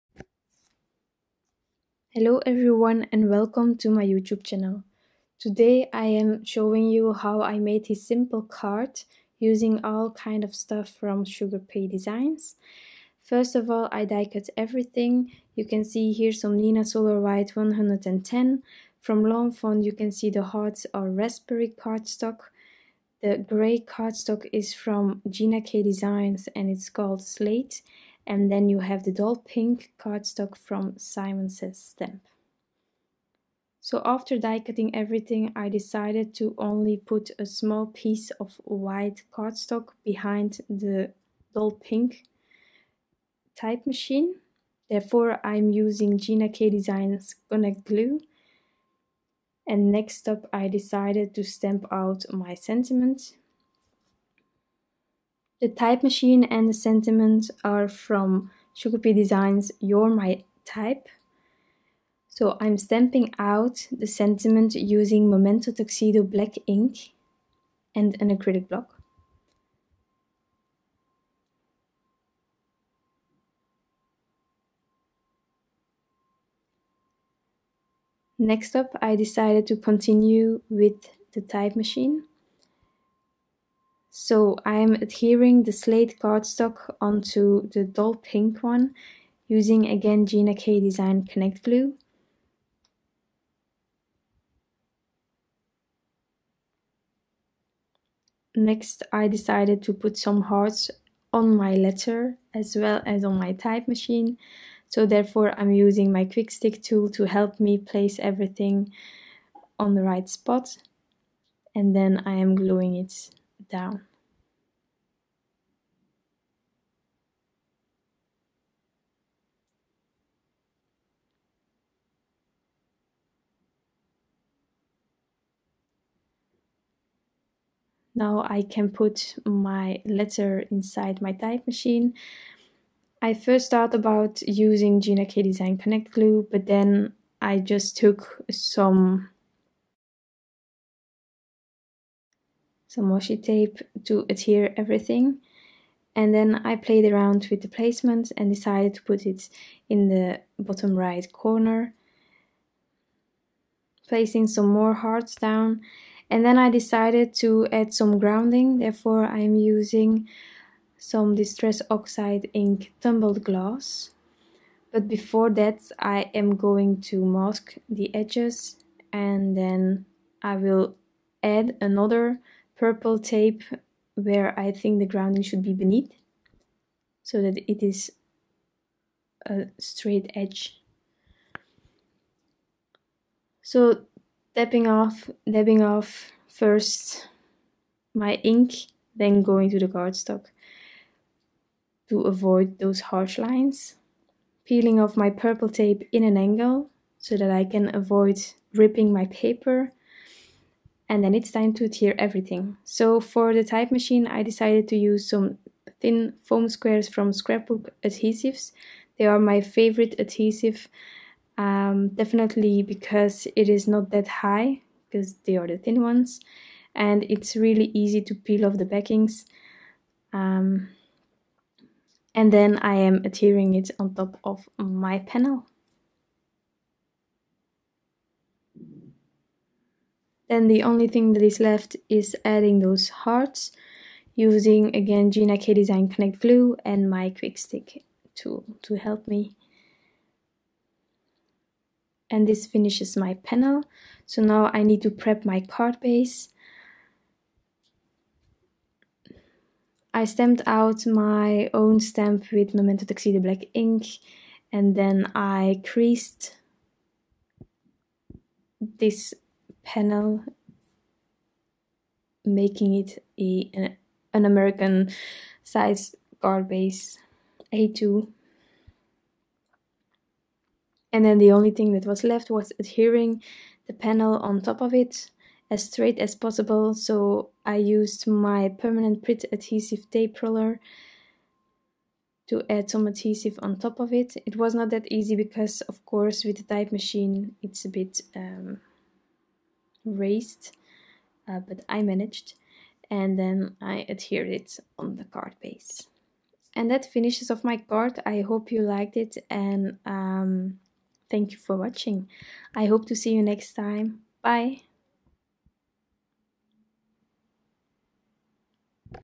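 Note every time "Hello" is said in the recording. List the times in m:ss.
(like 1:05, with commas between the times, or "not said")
0:02.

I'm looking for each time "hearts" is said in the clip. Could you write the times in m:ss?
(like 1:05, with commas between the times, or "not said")
0:20, 1:40, 2:34, 3:53.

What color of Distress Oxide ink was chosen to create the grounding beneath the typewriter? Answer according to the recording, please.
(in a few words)
Tumbled Glass.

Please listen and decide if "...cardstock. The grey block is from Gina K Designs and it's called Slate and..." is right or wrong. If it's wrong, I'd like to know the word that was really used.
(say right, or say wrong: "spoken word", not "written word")
wrong: "cardstock", not "block".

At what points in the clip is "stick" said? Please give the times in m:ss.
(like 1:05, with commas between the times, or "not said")
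1:46, 3:57.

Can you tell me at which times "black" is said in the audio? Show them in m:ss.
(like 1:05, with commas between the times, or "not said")
1:06, 4:13.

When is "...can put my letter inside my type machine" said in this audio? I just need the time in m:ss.
2:08.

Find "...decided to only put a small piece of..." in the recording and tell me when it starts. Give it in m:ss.
0:35.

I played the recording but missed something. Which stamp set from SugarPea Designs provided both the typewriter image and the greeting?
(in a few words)
You're My Type.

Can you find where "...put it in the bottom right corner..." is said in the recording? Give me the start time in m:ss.
2:29.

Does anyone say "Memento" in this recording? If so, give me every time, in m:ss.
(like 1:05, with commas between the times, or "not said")
1:05, 4:12.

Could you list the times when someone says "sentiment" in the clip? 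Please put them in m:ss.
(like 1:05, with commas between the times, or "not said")
0:52, 0:56, 1:04.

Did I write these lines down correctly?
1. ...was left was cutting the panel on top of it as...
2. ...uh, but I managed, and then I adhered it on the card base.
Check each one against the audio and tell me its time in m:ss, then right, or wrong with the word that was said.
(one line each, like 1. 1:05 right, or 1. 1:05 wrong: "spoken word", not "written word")
1. 4:32 wrong: "adhering", not "cutting"
2. 4:51 right.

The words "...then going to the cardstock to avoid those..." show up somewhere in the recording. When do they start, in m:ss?
3:09.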